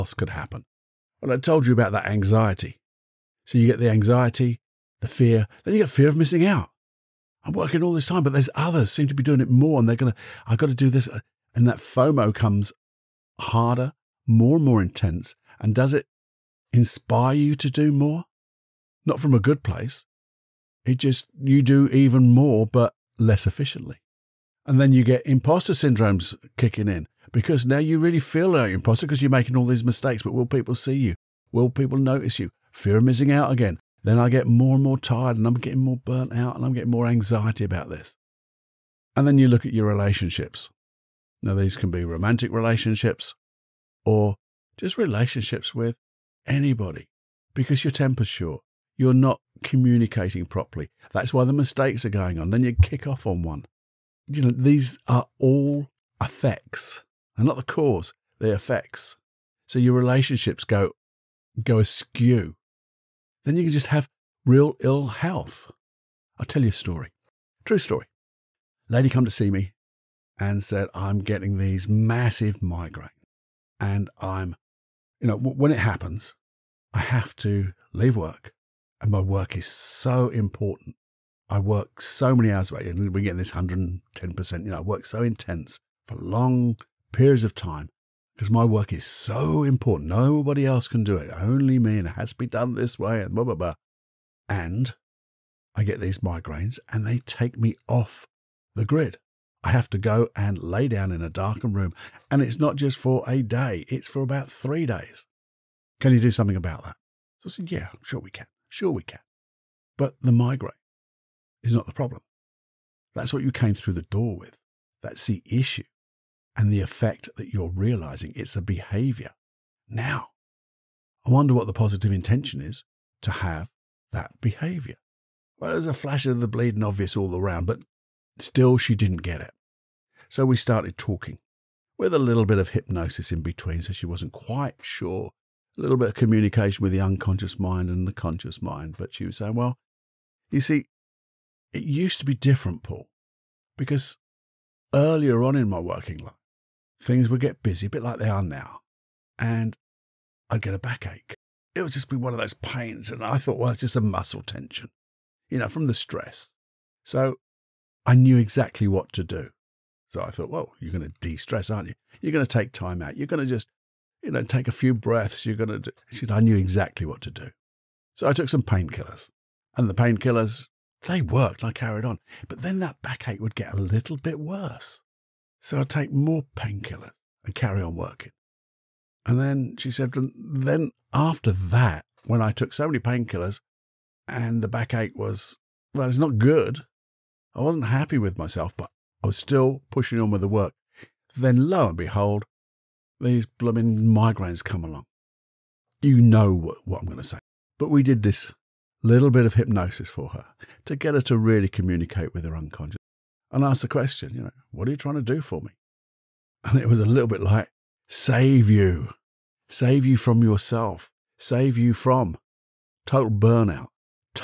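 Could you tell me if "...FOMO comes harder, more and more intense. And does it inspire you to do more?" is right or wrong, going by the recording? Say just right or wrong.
right.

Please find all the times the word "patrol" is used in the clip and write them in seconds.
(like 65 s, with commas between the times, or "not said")
not said.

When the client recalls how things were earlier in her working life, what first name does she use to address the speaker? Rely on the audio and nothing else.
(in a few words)
Paul.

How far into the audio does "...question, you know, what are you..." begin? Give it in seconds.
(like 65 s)
203 s.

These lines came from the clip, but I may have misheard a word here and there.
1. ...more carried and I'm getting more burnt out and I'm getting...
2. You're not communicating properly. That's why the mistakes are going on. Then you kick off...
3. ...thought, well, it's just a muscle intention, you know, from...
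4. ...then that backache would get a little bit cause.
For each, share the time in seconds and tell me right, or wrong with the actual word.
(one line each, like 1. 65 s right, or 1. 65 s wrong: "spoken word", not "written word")
1. 34 s wrong: "tired", not "carried"
2. 48 s right
3. 153 s wrong: "tension", not "intention"
4. 172 s wrong: "worse", not "cause".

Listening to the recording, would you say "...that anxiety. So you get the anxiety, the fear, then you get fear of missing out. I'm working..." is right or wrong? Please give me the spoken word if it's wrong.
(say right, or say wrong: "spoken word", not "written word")
right.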